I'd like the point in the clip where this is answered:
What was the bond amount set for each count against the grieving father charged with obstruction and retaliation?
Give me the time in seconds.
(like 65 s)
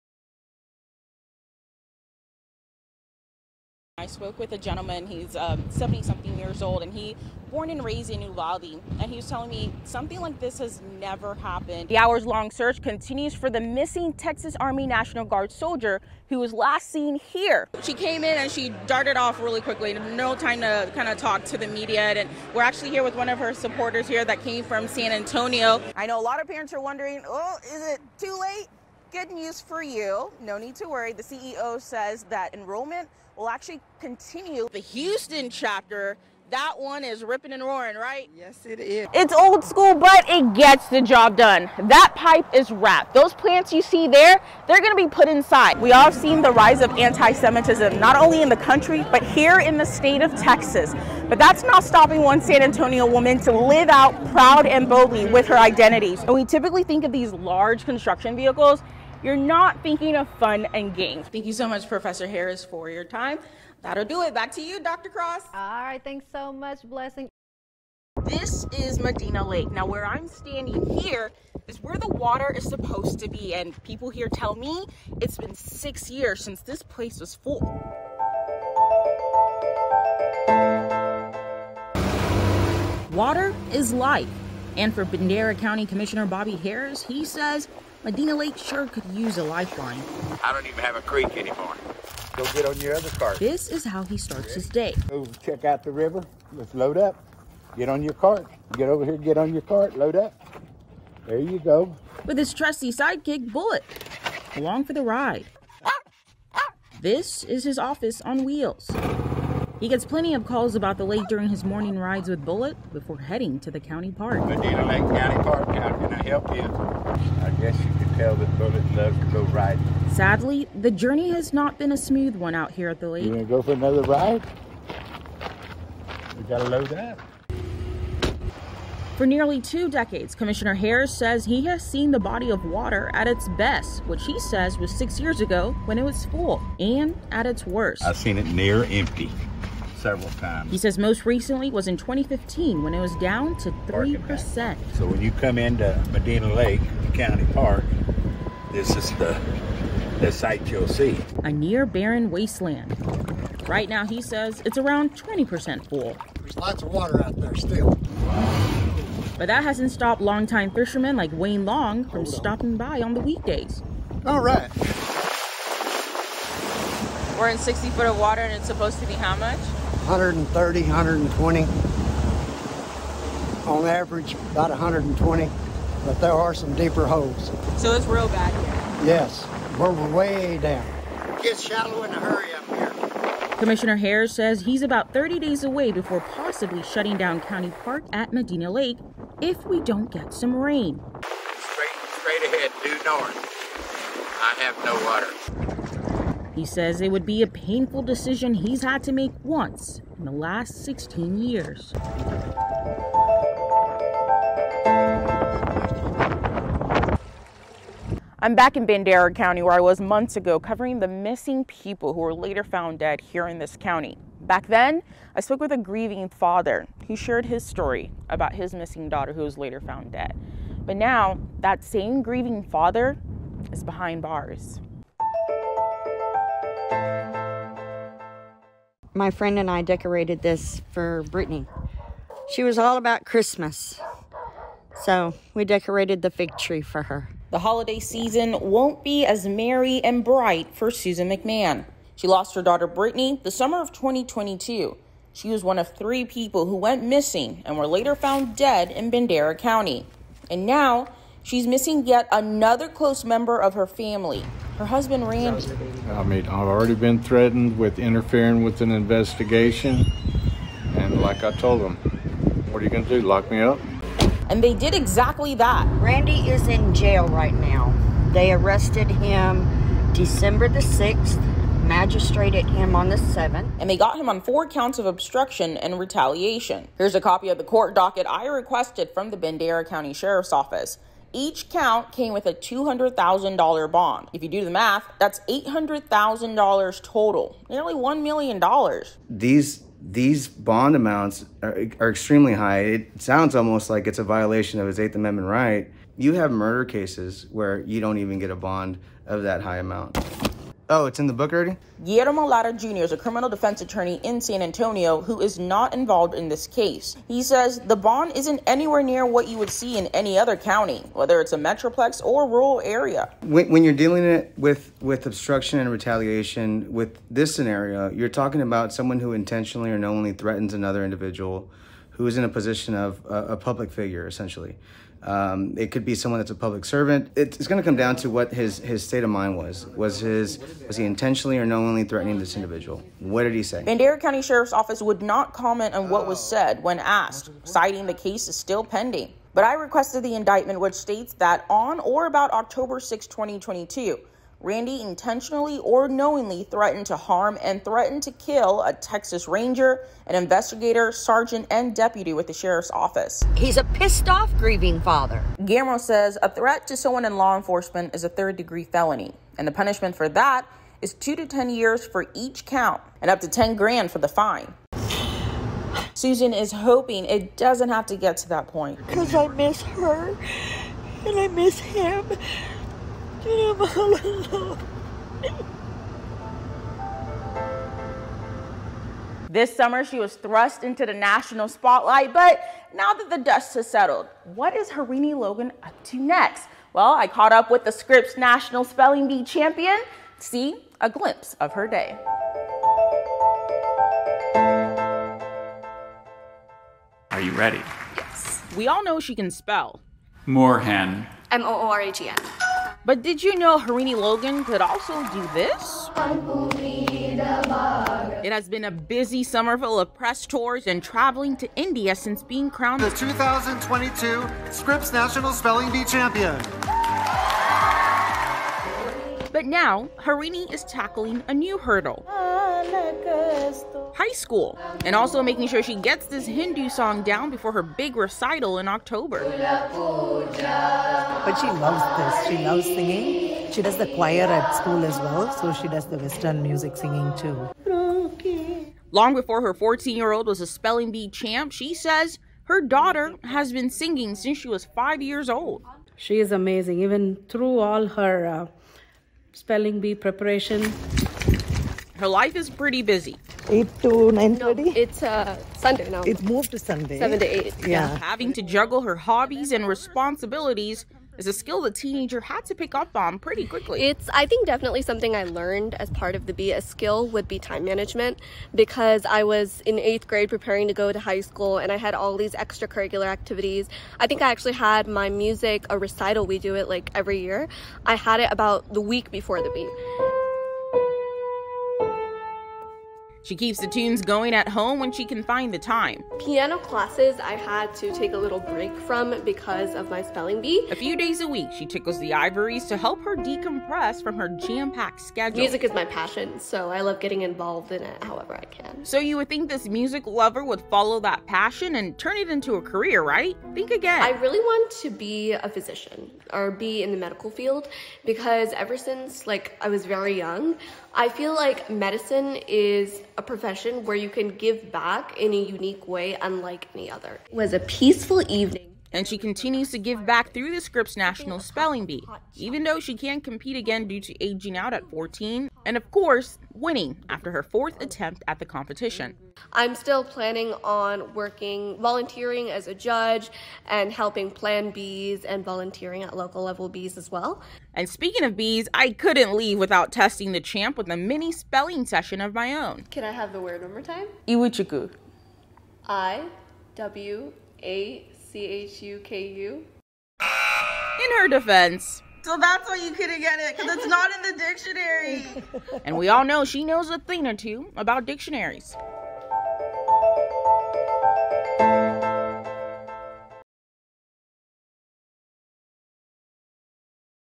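282 s.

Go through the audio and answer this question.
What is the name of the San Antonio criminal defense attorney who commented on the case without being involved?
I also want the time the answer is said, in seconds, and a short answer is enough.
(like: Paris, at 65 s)
Guillermo Lara Jr., at 302 s.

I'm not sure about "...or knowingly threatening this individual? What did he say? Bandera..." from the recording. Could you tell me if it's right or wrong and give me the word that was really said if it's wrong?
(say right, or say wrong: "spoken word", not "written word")
right.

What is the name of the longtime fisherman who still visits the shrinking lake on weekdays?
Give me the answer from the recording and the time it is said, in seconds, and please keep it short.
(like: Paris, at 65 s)
Wayne Long, at 161 s.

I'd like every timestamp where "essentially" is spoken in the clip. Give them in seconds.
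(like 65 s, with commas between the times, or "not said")
324 s.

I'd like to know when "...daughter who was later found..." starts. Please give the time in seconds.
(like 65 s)
219 s.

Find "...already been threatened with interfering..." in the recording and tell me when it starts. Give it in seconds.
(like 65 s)
256 s.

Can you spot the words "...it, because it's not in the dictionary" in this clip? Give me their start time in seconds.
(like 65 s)
553 s.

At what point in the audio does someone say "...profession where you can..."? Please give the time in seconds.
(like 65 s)
513 s.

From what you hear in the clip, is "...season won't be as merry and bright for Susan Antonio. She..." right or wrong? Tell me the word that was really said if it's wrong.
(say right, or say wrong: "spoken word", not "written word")
wrong: "McMahon", not "Antonio".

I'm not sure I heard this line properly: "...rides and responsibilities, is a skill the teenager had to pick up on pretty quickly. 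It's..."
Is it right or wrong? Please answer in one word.
wrong.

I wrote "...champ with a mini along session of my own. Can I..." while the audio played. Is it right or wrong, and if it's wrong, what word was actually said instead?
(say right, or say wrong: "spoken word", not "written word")
wrong: "spelling", not "along".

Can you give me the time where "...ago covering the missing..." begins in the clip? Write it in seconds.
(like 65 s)
210 s.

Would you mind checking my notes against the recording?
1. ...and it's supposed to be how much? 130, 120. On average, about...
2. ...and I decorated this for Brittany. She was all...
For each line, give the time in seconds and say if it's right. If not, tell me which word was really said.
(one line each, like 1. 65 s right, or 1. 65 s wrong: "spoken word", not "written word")
1. 168 s right
2. 229 s right.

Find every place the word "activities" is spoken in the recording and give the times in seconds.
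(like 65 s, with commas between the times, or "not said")
473 s.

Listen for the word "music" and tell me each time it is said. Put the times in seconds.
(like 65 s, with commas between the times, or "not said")
436 s, 475 s, 495 s, 499 s.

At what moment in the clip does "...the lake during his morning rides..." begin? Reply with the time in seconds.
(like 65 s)
110 s.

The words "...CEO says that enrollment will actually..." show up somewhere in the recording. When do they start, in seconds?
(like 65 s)
31 s.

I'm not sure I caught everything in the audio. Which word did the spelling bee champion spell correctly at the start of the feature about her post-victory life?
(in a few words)
Moorhen.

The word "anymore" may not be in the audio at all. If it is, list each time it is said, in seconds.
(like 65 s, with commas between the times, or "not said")
91 s.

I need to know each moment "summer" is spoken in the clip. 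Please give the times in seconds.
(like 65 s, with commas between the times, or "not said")
243 s, 379 s, 409 s.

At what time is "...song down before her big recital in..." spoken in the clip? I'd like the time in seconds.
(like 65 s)
426 s.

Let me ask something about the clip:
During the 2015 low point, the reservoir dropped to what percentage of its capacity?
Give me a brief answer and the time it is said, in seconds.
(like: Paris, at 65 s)
3%, at 143 s.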